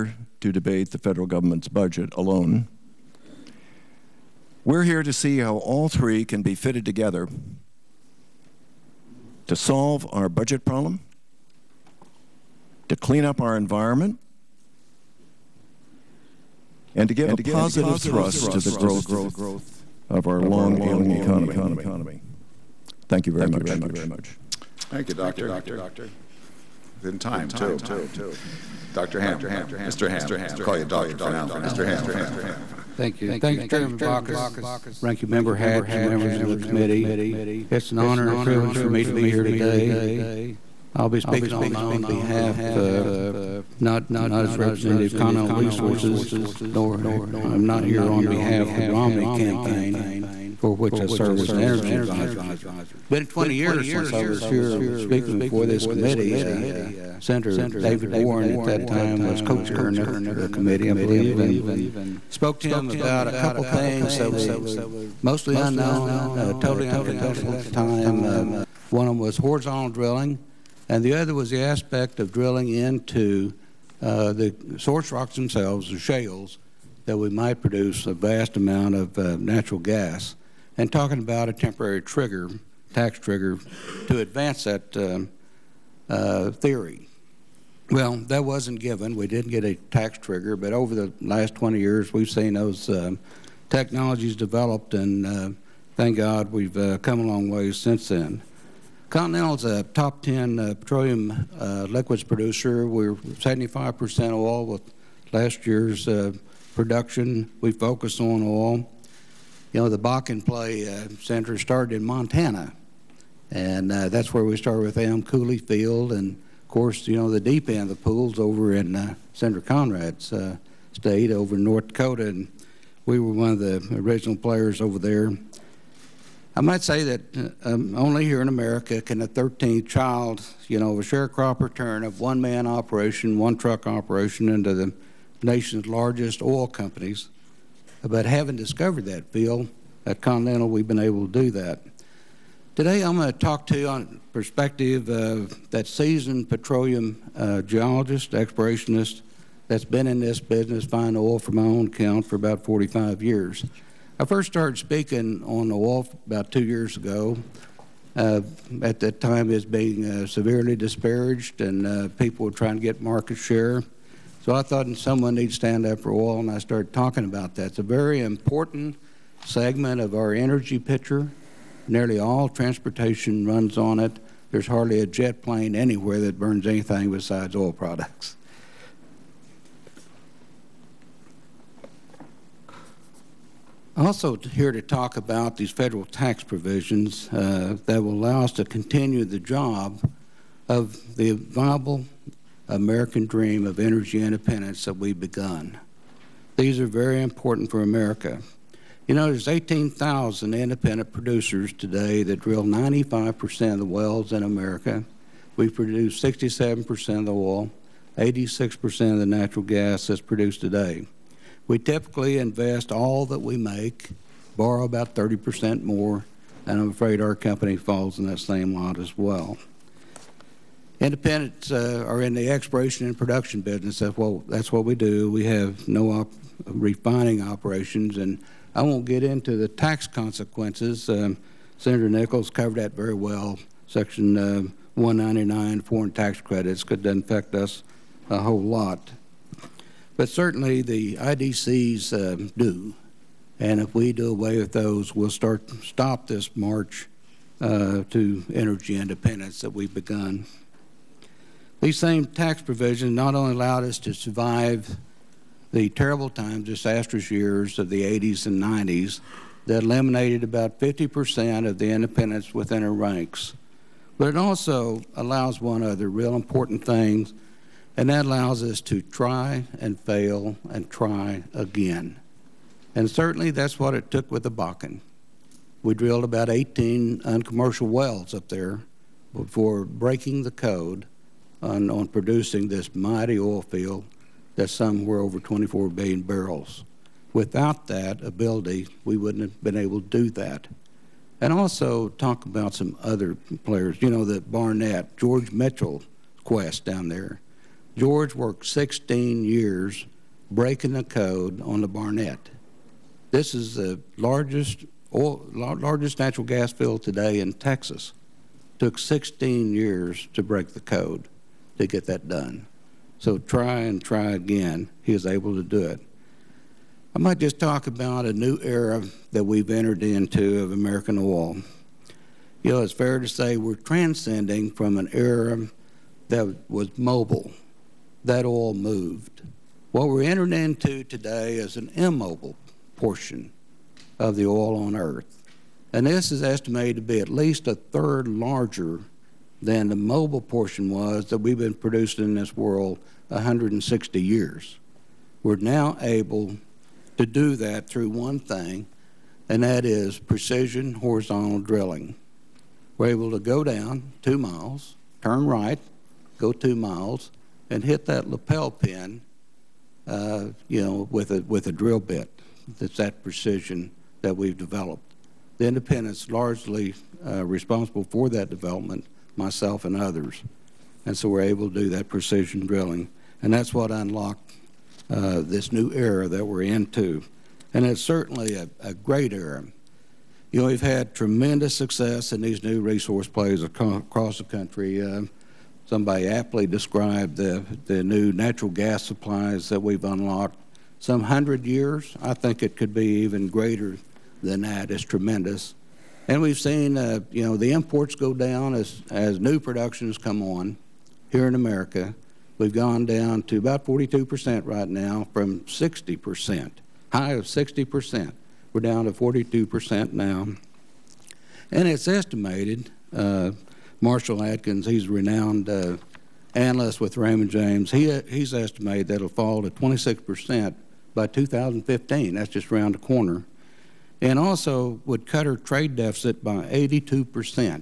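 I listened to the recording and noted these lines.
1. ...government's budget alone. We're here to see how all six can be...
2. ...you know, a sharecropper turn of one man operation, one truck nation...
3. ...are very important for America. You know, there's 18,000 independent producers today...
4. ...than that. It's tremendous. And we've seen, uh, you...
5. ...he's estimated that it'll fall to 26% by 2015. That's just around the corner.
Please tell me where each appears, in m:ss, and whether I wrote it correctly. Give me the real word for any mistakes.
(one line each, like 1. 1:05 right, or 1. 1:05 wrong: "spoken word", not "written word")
1. 0:01 wrong: "three", not "six"
2. 2:10 wrong: "operation", not "nation"
3. 3:16 right
4. 6:34 right
5. 6:58 right.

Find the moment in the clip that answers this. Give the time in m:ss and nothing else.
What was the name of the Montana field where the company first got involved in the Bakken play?
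1:55.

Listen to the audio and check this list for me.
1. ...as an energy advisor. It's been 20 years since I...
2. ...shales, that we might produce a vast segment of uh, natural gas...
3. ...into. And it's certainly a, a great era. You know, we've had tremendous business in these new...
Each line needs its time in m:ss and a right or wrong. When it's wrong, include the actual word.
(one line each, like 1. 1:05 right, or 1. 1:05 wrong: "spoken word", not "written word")
1. 0:51 right
2. 1:15 wrong: "amount", not "segment"
3. 6:16 wrong: "success", not "business".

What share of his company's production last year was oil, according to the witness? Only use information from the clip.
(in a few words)
75%.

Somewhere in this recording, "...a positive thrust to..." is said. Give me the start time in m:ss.
0:17.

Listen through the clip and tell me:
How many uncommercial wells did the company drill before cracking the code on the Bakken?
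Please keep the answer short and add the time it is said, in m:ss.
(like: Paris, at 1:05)
18, at 4:36.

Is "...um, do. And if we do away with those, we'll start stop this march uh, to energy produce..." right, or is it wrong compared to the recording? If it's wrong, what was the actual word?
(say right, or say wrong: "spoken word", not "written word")
wrong: "independence", not "produce".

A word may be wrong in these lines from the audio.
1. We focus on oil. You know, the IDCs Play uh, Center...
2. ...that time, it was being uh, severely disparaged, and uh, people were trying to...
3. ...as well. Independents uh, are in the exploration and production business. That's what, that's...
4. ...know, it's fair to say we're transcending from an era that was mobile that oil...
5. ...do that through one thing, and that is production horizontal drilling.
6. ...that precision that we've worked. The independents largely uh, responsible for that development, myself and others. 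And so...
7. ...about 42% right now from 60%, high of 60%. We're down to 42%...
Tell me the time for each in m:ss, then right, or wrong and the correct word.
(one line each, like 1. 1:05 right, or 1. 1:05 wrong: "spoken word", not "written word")
1. 1:47 wrong: "Bakken", not "IDCs"
2. 2:38 right
3. 3:38 right
4. 5:22 right
5. 5:47 wrong: "precision", not "production"
6. 6:02 wrong: "developed", not "worked"
7. 6:43 right.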